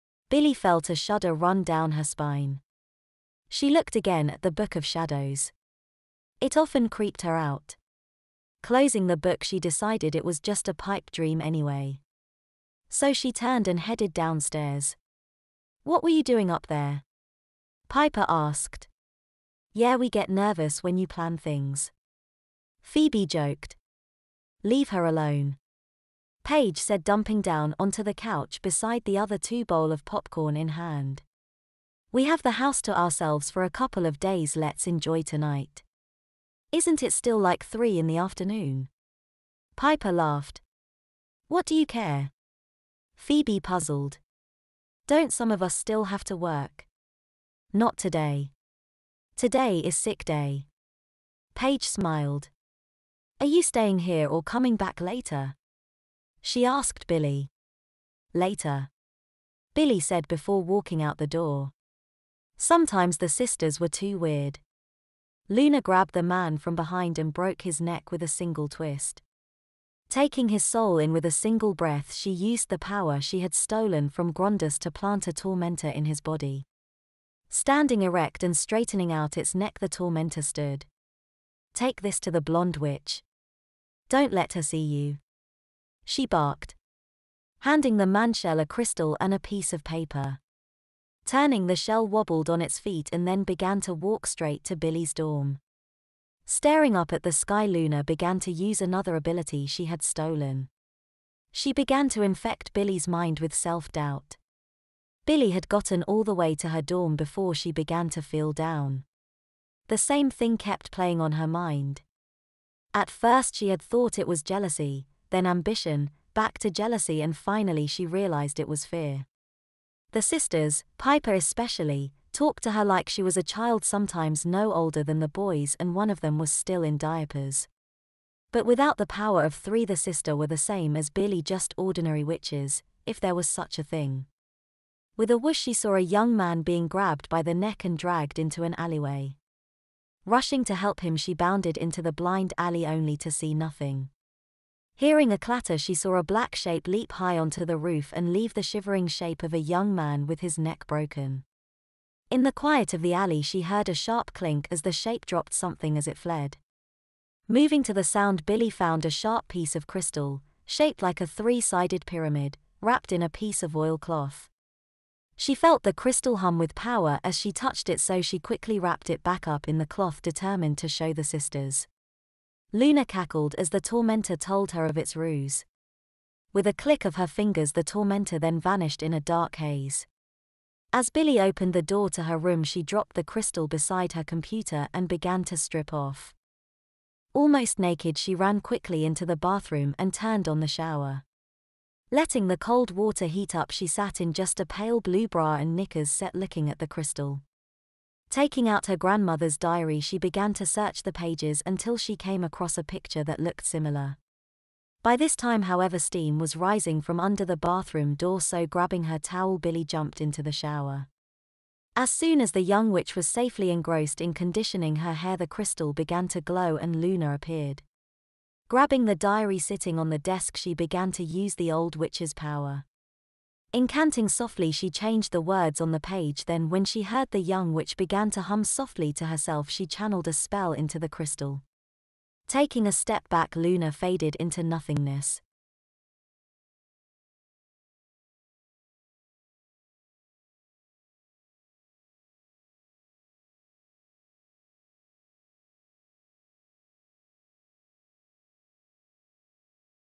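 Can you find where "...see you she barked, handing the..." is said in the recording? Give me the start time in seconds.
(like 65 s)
84 s.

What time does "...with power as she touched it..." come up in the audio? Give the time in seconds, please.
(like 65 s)
166 s.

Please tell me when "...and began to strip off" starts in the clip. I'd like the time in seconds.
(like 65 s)
184 s.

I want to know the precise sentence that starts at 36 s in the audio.
Isn't it still like three in the afternoon?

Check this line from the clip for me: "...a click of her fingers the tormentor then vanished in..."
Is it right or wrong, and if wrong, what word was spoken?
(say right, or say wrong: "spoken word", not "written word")
right.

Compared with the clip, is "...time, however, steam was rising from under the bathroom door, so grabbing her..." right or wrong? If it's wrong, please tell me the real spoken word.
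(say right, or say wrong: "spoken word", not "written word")
right.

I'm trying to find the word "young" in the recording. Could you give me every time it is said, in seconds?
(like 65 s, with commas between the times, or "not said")
136 s, 149 s, 212 s, 227 s.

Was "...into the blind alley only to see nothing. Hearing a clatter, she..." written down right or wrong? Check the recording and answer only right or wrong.
right.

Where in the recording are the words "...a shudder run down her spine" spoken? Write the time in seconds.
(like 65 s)
0 s.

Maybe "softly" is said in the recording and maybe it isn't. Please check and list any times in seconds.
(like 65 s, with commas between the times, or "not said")
224 s, 228 s.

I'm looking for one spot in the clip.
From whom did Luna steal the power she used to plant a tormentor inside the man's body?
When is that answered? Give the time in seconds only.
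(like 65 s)
74 s.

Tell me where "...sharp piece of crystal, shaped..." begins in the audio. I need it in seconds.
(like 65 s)
159 s.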